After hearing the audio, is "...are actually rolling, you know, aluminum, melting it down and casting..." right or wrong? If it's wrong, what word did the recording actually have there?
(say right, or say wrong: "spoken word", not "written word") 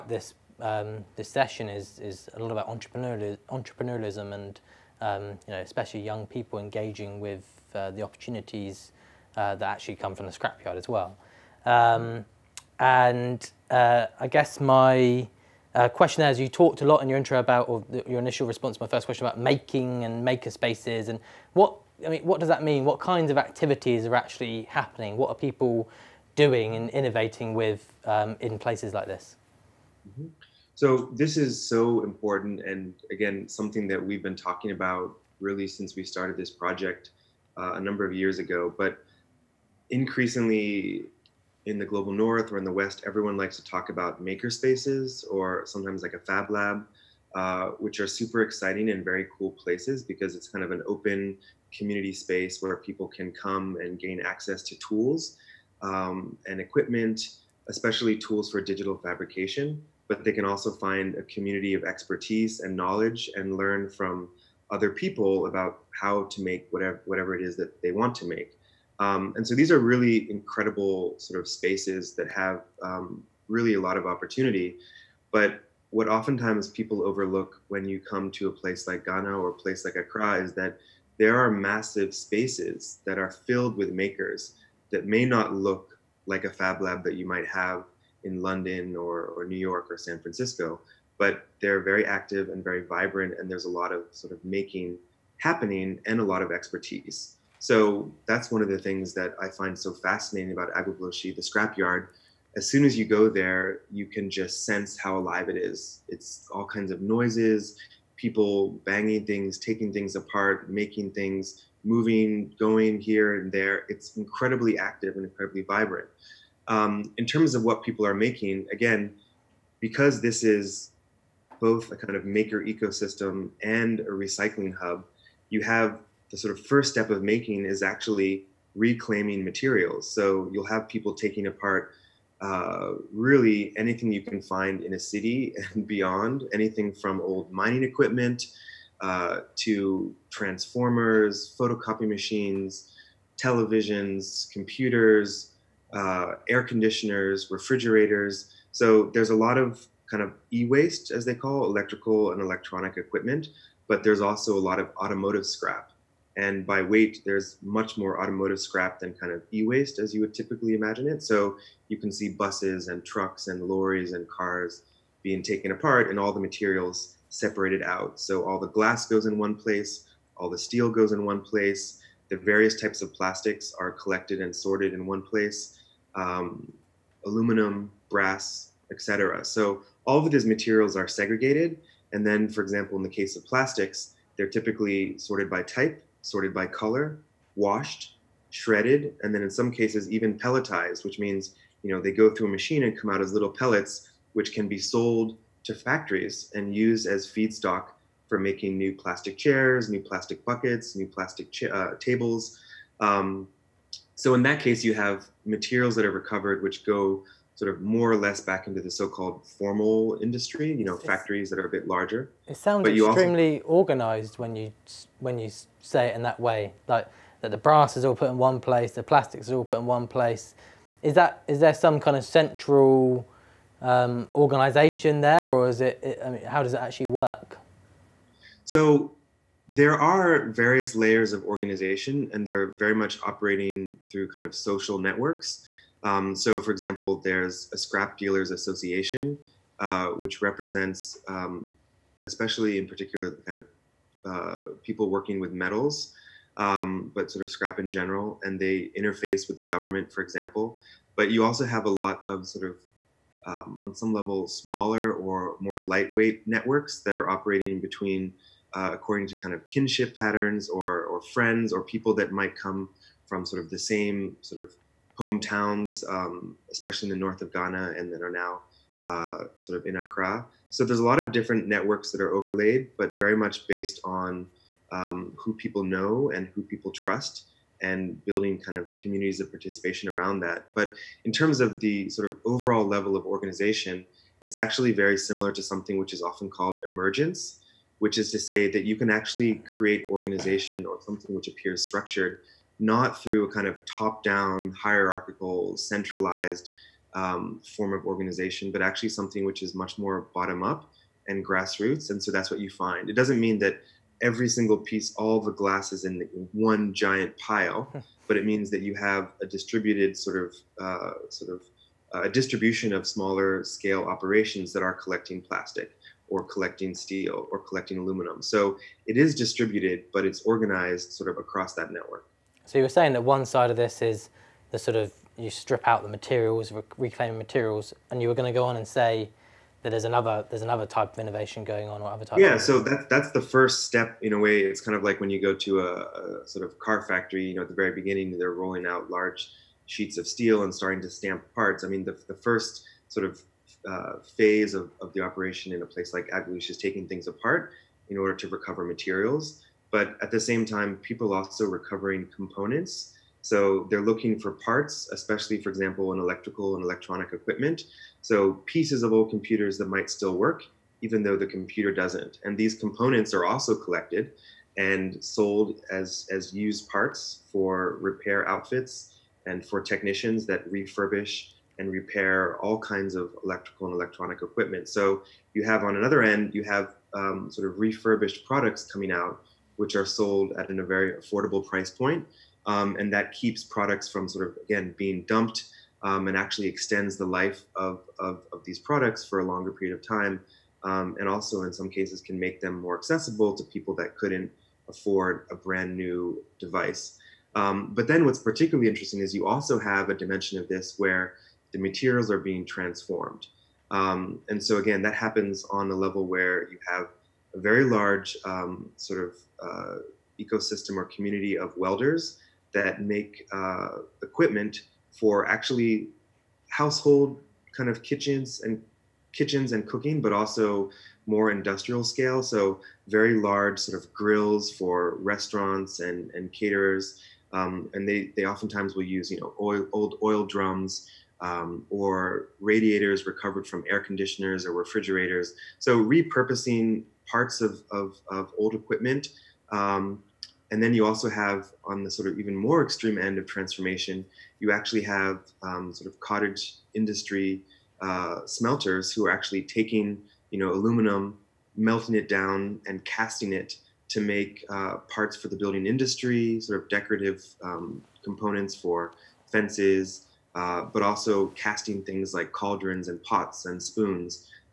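wrong: "taking", not "rolling".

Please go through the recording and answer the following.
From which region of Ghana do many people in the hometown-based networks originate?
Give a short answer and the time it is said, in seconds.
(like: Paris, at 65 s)
The north, at 267 s.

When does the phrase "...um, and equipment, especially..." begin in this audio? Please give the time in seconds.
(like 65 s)
55 s.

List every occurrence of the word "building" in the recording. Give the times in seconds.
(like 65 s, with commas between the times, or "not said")
278 s, 455 s.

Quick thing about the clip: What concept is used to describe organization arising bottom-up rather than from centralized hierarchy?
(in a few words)
Emergence.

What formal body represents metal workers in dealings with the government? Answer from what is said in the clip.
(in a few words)
Scrap dealers association.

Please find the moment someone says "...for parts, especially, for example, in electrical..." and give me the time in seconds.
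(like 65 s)
354 s.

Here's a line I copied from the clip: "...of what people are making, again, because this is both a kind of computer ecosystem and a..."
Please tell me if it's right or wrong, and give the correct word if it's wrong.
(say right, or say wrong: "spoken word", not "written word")
wrong: "maker", not "computer".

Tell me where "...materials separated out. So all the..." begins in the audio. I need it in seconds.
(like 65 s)
166 s.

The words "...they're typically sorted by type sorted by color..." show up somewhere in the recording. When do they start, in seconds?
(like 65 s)
184 s.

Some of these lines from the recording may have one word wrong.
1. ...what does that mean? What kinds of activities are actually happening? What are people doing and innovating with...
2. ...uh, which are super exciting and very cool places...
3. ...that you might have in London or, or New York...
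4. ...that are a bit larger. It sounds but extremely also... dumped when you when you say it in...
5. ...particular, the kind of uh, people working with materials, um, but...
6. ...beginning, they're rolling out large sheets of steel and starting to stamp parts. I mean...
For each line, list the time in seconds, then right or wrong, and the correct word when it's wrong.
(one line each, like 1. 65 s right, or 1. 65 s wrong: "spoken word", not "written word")
1. 22 s right
2. 47 s right
3. 87 s right
4. 211 s wrong: "organized", not "dumped"
5. 242 s wrong: "metals", not "materials"
6. 337 s right.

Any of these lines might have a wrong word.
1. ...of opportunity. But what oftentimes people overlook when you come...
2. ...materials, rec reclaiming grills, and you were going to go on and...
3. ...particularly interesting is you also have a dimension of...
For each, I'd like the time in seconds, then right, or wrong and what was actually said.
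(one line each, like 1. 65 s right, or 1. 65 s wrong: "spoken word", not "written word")
1. 73 s right
2. 326 s wrong: "materials", not "grills"
3. 398 s right.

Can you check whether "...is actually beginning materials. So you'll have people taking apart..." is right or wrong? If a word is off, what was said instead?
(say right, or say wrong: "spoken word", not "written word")
wrong: "reclaiming", not "beginning".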